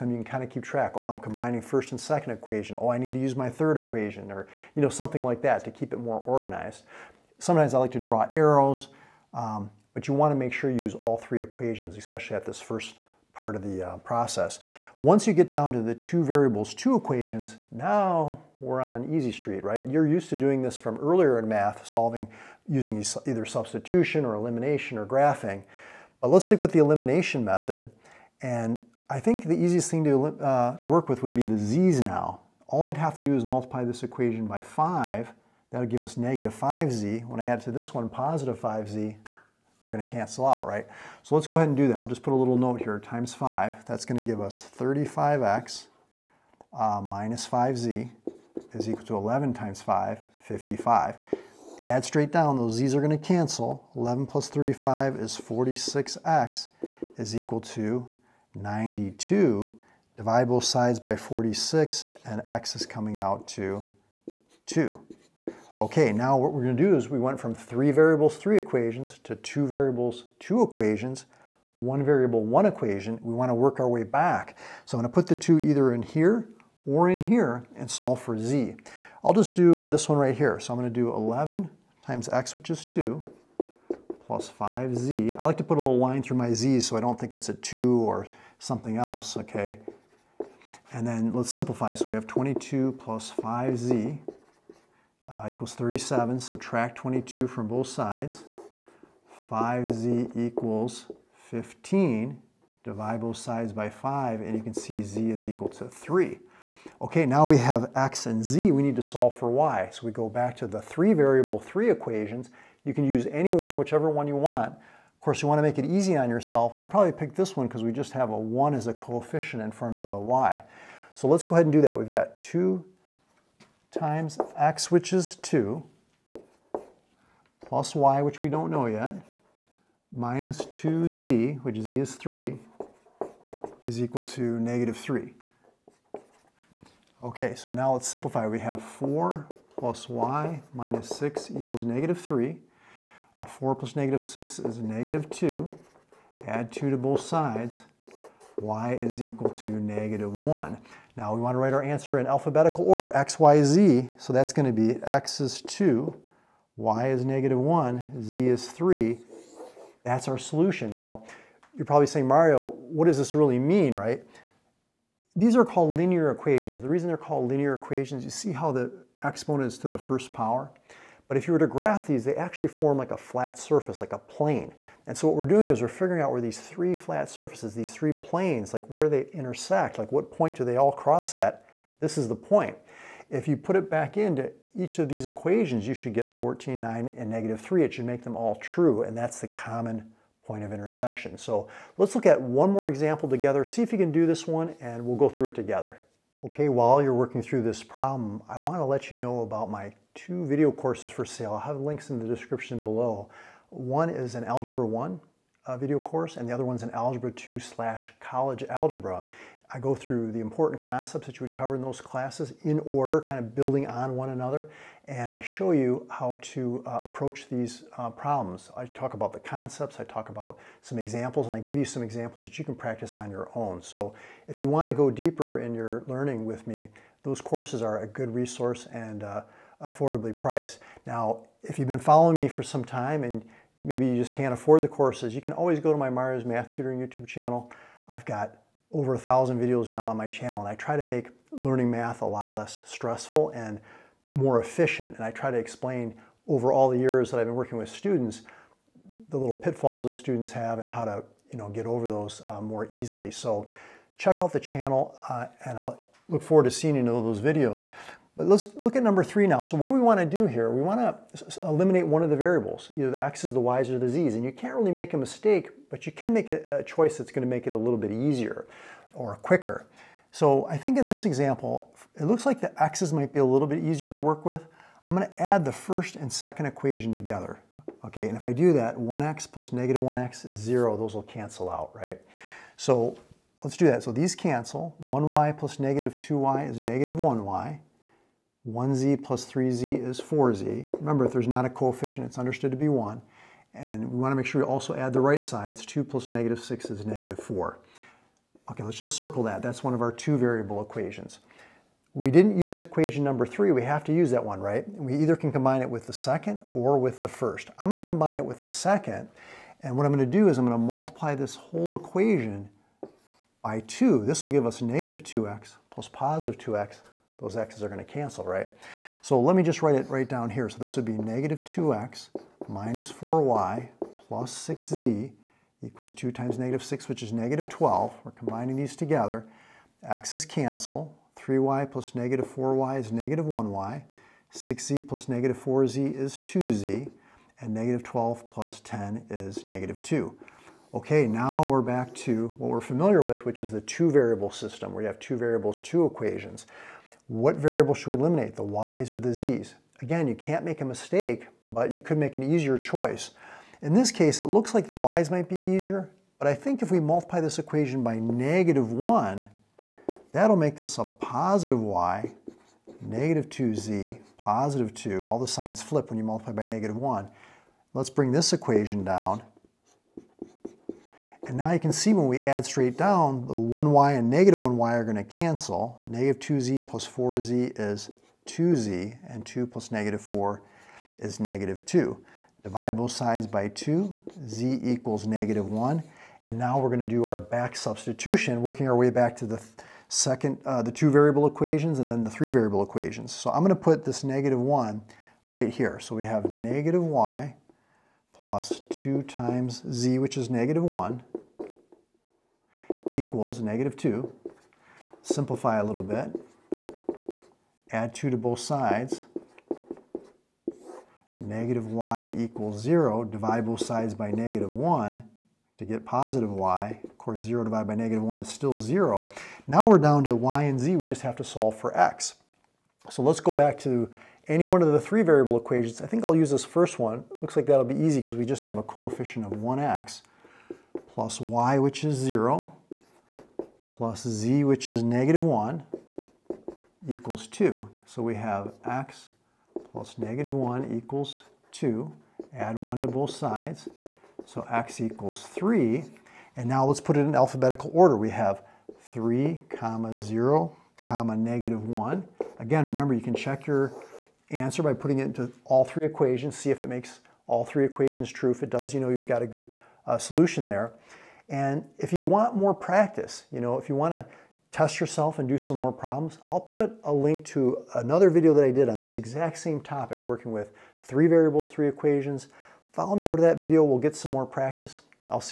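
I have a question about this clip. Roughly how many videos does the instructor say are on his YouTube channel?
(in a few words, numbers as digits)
over 1000.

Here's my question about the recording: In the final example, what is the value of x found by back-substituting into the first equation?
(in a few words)
3.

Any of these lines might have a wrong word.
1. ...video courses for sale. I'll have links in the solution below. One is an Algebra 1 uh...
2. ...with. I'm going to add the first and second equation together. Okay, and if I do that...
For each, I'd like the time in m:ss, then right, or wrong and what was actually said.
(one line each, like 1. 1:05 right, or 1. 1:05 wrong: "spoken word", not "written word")
1. 3:20 wrong: "description", not "solution"
2. 4:34 right.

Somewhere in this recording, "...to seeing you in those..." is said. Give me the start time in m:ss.
4:16.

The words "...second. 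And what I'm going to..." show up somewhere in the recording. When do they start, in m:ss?
5:08.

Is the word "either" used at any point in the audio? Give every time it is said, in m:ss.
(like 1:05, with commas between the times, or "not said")
0:23, 1:15, 4:22, 5:05.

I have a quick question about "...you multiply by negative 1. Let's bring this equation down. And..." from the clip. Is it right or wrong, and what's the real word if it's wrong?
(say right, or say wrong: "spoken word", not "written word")
right.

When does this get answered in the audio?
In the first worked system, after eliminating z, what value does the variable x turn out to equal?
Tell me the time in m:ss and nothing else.
1:02.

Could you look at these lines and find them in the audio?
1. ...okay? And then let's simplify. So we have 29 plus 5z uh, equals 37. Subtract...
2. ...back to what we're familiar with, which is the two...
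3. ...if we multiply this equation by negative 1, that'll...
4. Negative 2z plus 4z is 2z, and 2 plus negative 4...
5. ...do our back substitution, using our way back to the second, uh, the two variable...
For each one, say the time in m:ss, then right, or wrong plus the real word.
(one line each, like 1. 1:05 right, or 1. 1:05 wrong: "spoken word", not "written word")
1. 1:29 wrong: "22", not "29"
2. 5:41 right
3. 5:56 right
4. 6:16 right
5. 6:27 wrong: "working", not "using".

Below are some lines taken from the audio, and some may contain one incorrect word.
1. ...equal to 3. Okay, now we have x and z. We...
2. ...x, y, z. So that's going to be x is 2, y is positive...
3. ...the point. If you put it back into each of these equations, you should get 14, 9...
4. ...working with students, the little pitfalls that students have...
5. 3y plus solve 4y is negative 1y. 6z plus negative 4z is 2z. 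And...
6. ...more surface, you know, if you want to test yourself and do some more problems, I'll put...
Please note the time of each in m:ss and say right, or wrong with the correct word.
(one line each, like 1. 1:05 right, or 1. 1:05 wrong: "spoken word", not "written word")
1. 1:45 right
2. 2:33 wrong: "negative", not "positive"
3. 3:02 right
4. 4:07 right
5. 5:31 wrong: "negative", not "solve"
6. 7:42 wrong: "practice", not "surface".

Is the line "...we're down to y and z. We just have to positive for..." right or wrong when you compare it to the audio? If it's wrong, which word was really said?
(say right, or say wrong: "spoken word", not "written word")
wrong: "solve", not "positive".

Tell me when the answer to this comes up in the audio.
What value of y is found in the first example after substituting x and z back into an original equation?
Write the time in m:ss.
2:28.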